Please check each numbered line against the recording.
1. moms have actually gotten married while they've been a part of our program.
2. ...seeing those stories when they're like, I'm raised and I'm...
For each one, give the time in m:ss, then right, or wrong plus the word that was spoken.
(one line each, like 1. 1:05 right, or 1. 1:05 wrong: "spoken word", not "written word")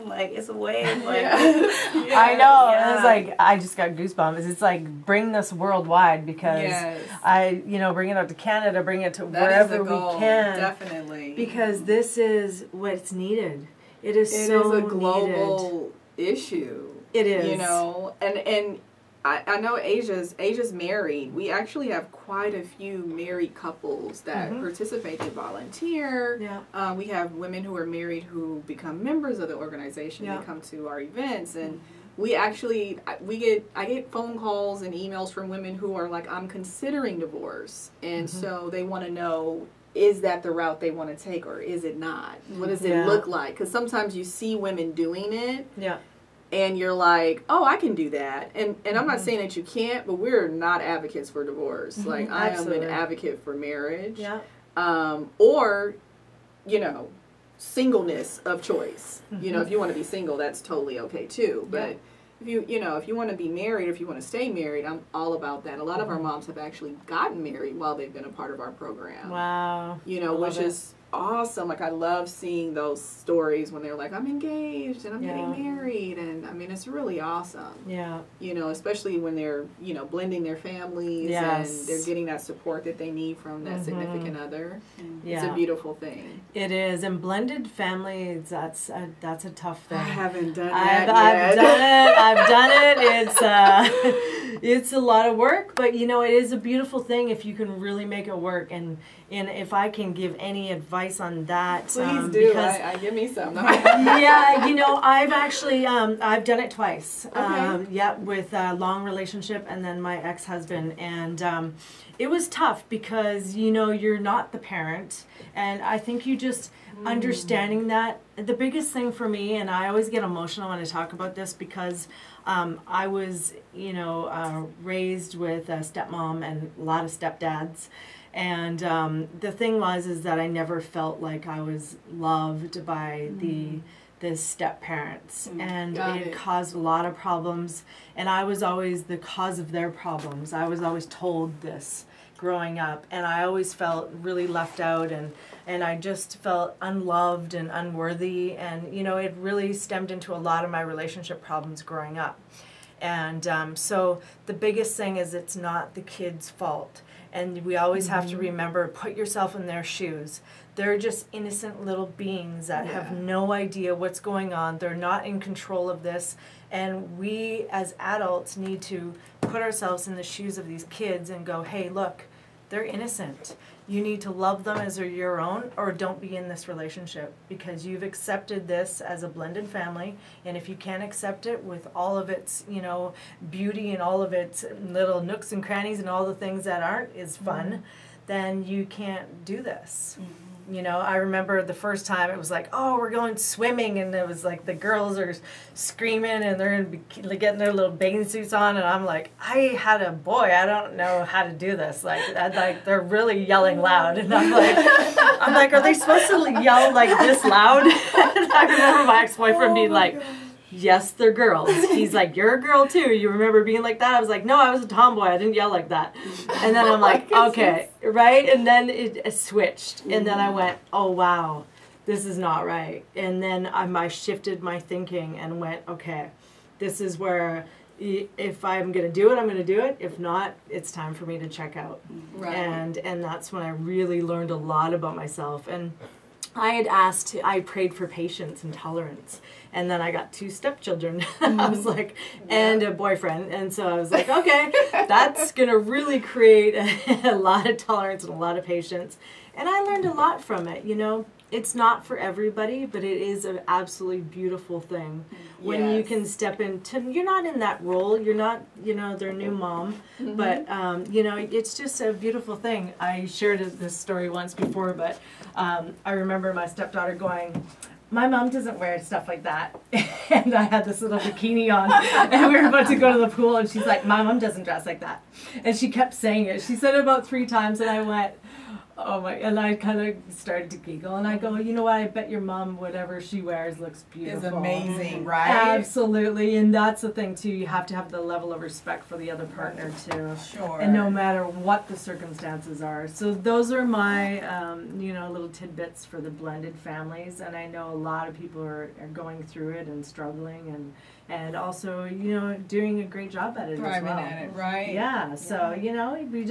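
1. 1:06 right
2. 1:12 wrong: "engaged", not "raised".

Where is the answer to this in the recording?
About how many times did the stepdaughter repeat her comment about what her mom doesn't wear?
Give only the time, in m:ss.
4:37.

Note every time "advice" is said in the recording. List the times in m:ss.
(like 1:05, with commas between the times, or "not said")
1:40.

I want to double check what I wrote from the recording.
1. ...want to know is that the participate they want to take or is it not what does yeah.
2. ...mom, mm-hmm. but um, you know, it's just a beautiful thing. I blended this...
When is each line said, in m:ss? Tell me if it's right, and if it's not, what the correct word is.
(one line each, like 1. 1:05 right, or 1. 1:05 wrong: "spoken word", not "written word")
1. 0:38 wrong: "route", not "participate"
2. 4:19 wrong: "shared", not "blended".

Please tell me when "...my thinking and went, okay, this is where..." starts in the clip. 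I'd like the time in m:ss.
3:44.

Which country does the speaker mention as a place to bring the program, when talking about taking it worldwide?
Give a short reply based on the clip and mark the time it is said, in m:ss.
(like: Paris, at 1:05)
Canada, at 0:08.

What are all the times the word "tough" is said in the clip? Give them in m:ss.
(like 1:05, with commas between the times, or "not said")
1:29, 1:52.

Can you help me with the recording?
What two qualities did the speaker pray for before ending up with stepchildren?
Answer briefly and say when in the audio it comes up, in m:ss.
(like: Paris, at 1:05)
patience and tolerance, at 3:58.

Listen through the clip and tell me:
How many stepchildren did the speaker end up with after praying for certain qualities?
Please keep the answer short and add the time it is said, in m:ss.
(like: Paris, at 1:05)
2, at 4:00.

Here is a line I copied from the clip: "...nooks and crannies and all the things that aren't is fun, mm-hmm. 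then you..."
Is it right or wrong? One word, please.
right.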